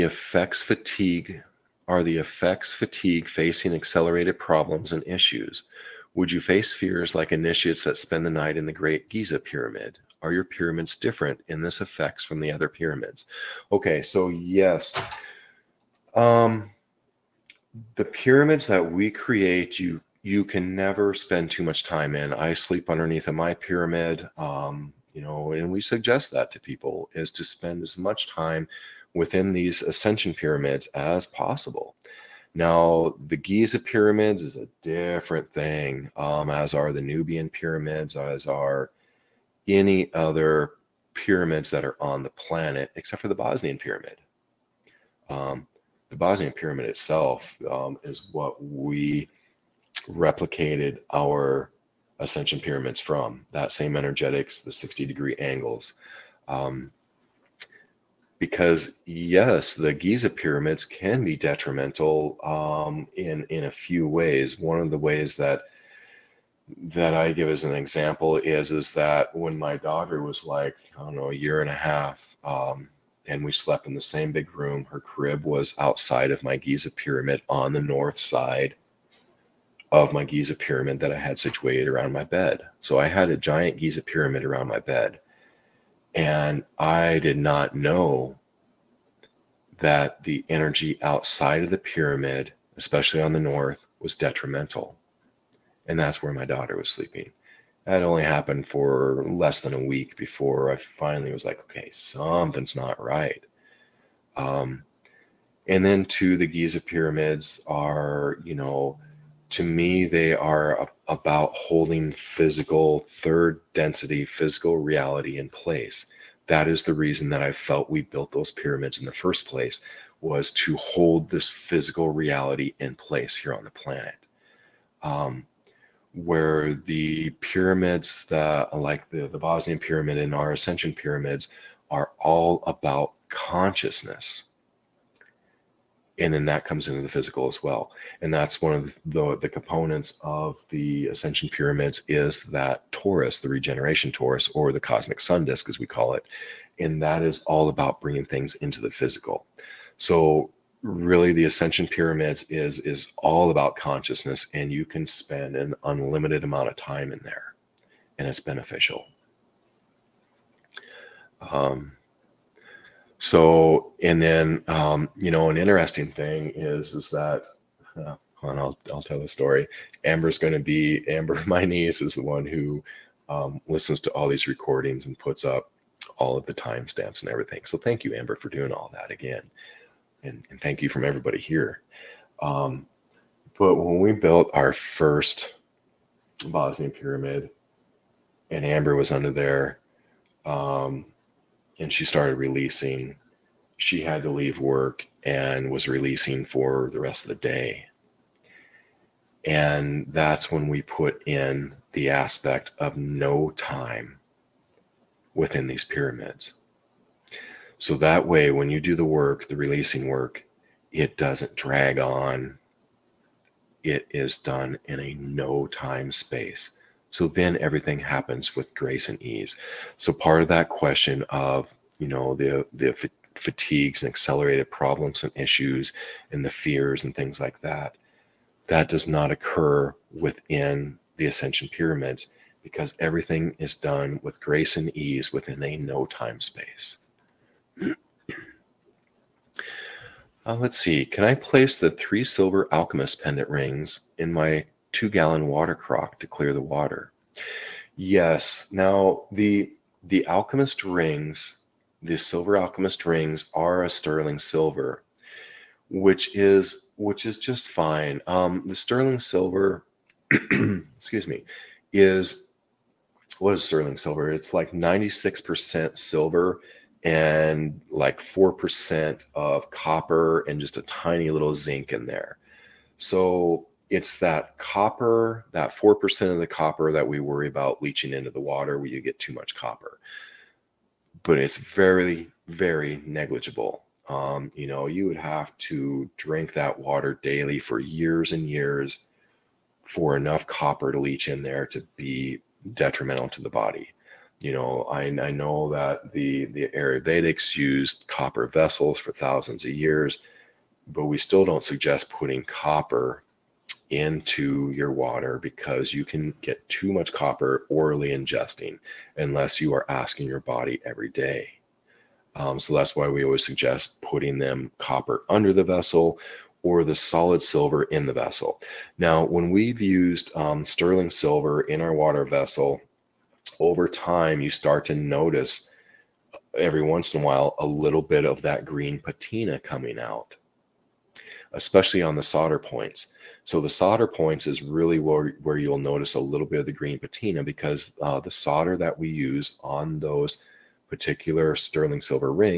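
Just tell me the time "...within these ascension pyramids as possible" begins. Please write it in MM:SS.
00:29.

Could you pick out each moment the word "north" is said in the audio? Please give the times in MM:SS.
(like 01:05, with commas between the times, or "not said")
01:17, 01:33.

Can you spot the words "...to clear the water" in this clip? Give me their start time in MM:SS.
04:06.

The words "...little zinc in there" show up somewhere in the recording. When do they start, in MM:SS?
04:31.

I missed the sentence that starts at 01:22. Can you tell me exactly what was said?
So I had a giant Giza pyramid around my bed.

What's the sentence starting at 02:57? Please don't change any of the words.
So thank you, Amber, for doing all that again.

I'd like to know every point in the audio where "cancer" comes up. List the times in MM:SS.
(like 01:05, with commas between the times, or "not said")
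not said.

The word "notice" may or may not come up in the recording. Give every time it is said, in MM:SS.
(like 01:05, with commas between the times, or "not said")
05:24, 05:35.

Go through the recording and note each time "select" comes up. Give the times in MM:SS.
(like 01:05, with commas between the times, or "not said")
not said.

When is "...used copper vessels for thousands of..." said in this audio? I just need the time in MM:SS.
04:57.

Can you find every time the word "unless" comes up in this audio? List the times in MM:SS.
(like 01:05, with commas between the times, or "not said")
05:09.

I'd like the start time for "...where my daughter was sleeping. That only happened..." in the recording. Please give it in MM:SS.
01:36.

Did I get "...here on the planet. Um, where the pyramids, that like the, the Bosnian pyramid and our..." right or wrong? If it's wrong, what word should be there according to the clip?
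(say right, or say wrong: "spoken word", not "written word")
right.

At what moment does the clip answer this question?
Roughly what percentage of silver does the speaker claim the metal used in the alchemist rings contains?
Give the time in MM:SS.
04:24.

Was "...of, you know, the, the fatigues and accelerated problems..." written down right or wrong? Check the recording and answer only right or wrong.
right.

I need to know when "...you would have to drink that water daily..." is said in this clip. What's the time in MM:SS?
04:44.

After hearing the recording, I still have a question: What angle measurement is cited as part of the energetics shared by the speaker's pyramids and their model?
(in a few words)
60 degree.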